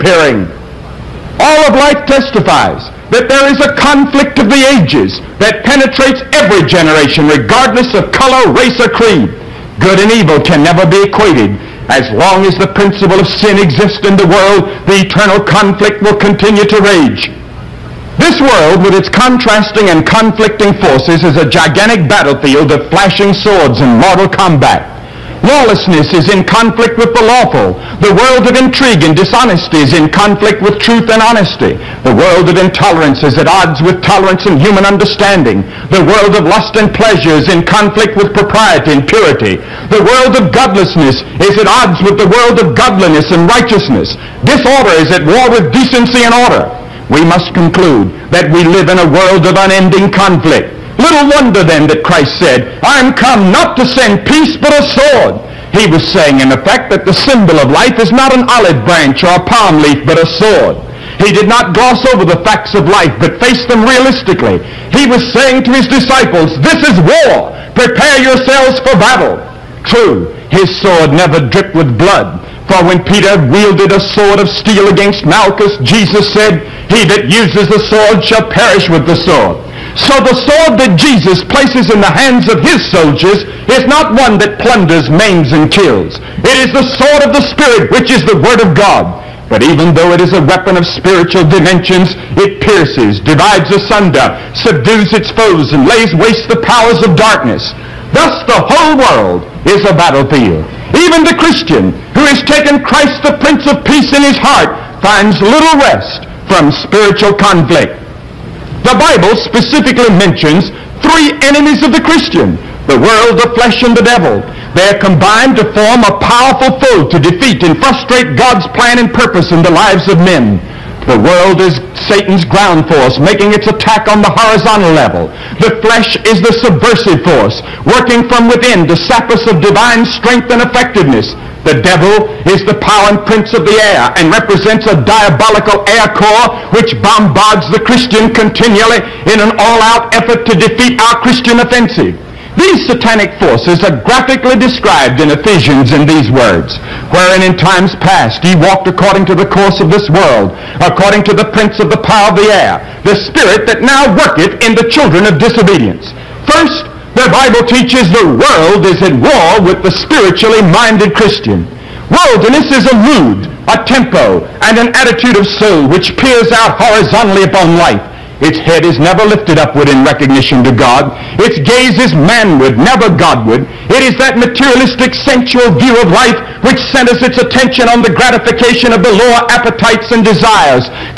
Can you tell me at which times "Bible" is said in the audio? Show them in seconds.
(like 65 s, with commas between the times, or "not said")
108 s, 157 s.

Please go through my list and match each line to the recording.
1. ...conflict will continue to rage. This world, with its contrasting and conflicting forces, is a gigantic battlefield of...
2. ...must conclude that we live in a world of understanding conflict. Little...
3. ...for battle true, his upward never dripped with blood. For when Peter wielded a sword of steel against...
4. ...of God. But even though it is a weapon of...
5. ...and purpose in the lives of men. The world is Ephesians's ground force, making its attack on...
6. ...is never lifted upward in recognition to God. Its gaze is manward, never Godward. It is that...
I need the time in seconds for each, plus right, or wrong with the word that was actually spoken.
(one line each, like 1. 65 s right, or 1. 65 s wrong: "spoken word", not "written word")
1. 15 s right
2. 47 s wrong: "unending", not "understanding"
3. 68 s wrong: "sword", not "upward"
4. 88 s right
5. 118 s wrong: "Satan", not "Ephesians"
6. 168 s right.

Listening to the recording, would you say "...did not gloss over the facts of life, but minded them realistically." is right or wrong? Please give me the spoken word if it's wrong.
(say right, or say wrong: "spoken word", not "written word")
wrong: "faced", not "minded".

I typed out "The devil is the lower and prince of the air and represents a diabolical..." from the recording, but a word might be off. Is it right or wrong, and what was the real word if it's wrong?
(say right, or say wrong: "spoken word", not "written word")
wrong: "power", not "lower".